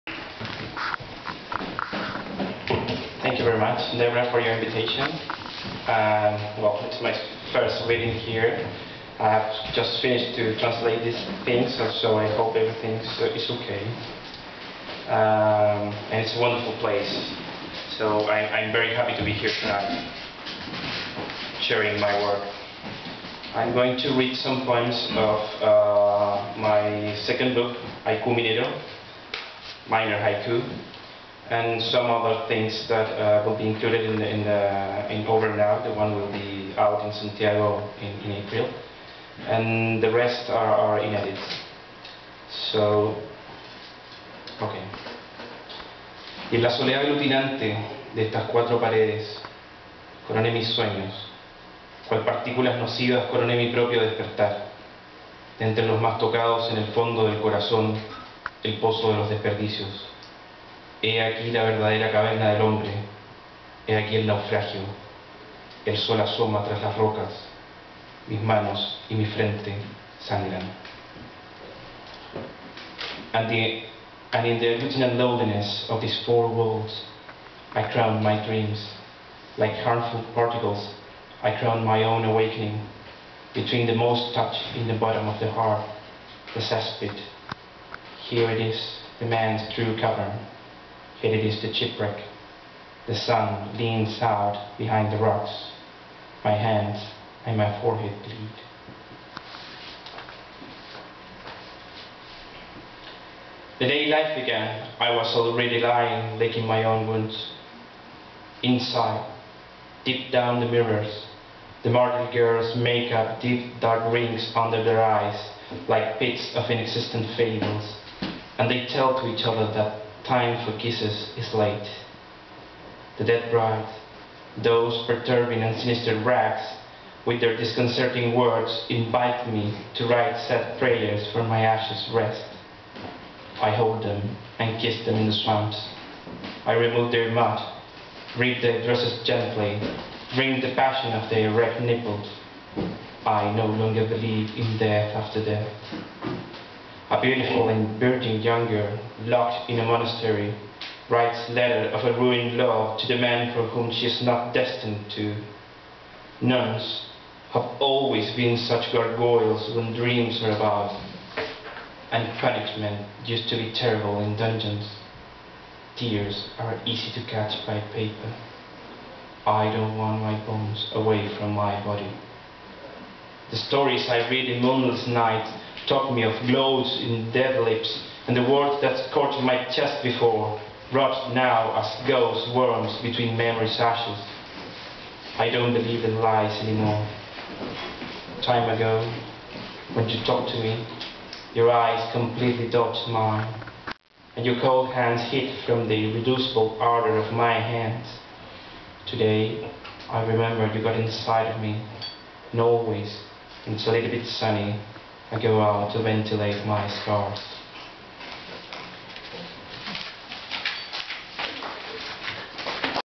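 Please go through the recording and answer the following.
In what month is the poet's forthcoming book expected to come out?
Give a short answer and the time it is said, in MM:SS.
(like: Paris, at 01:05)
April, at 00:38.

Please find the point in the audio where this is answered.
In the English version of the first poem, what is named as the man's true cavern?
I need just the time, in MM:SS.
01:26.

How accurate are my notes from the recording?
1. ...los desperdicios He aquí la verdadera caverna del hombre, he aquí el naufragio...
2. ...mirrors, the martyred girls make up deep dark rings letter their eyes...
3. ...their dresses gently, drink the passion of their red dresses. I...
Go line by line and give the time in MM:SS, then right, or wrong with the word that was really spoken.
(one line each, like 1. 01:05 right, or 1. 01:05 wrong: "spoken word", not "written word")
1. 00:59 right
2. 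01:50 wrong: "under", not "letter"
3. 02:18 wrong: "nipples", not "dresses".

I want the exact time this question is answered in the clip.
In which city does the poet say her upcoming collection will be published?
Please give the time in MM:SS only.
00:37.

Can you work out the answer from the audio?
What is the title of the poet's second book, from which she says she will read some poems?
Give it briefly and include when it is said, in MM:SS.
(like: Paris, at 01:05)
Haiku Minero, at 00:28.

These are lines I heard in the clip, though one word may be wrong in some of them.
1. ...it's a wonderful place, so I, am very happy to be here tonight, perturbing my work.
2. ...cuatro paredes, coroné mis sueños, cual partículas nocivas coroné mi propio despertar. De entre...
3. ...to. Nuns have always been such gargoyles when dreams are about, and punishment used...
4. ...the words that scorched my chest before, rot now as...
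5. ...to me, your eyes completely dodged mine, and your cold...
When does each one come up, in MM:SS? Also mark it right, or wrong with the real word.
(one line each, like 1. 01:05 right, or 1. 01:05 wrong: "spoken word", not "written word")
1. 00:16 wrong: "sharing", not "perturbing"
2. 00:48 right
3. 02:35 right
4. 02:58 right
5. 03:10 right.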